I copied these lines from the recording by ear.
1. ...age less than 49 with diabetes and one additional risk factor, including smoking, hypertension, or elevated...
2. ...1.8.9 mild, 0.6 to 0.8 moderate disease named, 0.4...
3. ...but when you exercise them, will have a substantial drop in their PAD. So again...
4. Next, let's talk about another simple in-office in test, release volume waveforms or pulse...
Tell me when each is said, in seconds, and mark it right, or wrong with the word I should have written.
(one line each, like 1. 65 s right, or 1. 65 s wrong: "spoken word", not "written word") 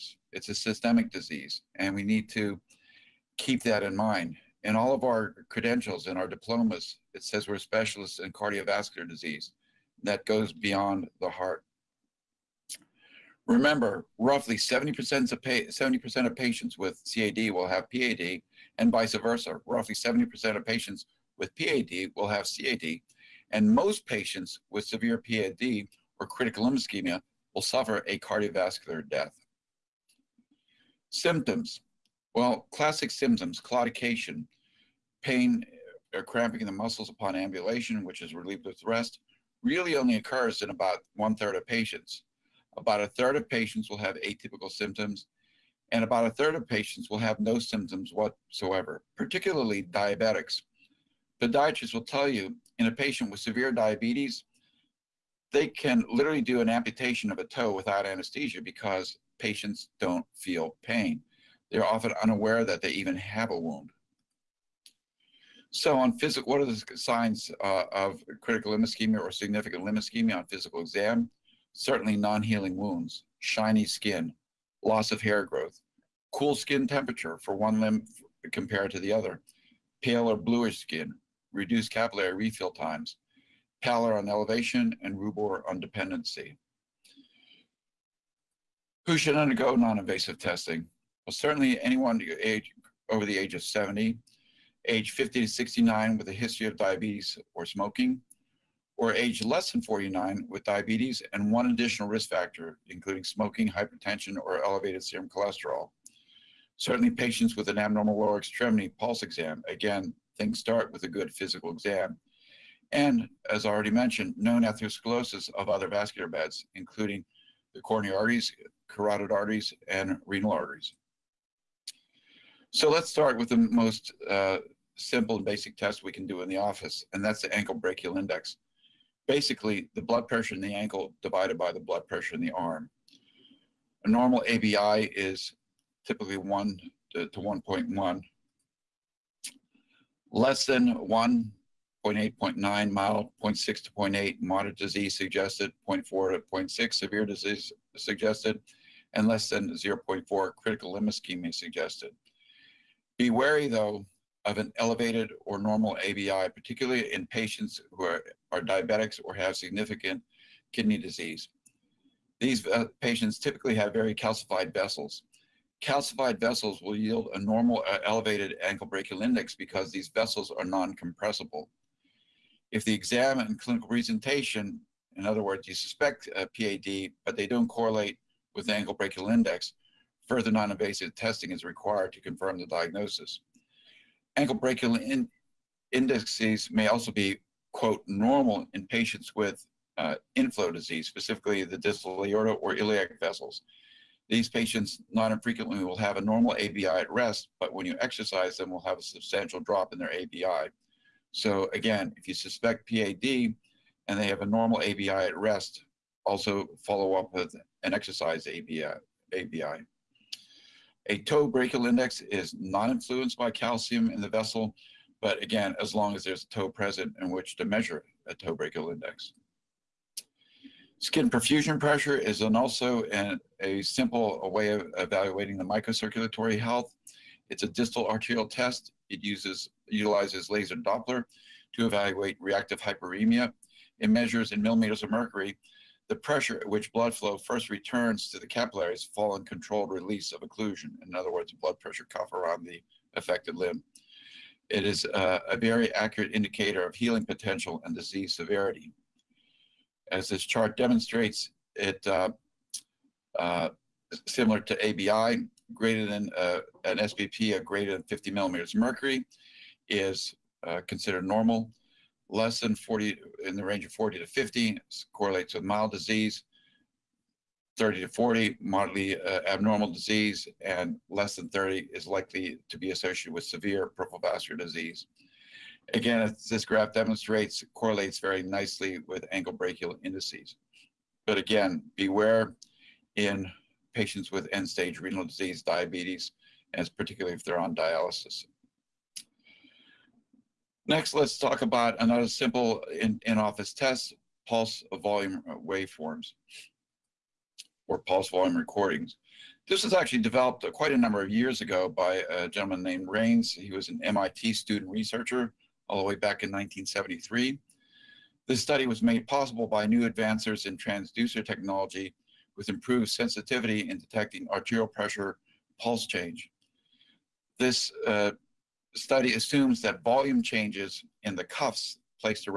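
1. 99 s right
2. 141 s wrong: "suggested", not "named"
3. 197 s wrong: "ABI", not "PAD"
4. 290 s wrong: "pulse", not "release".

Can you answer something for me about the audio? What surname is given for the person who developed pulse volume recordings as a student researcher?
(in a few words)
Raines.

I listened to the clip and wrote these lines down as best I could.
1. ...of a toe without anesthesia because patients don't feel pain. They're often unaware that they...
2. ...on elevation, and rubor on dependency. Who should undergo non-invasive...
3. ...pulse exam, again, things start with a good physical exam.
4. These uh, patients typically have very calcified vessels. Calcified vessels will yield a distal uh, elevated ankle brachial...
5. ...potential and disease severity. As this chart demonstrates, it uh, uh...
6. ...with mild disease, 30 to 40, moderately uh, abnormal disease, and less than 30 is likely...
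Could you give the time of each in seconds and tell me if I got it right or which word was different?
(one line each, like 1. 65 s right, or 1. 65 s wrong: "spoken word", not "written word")
1. 57 s right
2. 84 s right
3. 108 s right
4. 162 s wrong: "normal", not "distal"
5. 247 s right
6. 265 s right.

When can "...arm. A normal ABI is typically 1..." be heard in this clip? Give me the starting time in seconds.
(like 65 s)
132 s.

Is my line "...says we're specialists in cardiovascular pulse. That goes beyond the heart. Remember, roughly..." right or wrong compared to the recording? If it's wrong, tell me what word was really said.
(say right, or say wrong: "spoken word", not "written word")
wrong: "disease", not "pulse".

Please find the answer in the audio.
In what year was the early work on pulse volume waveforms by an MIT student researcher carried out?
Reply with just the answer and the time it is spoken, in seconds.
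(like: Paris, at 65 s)
1973, at 306 s.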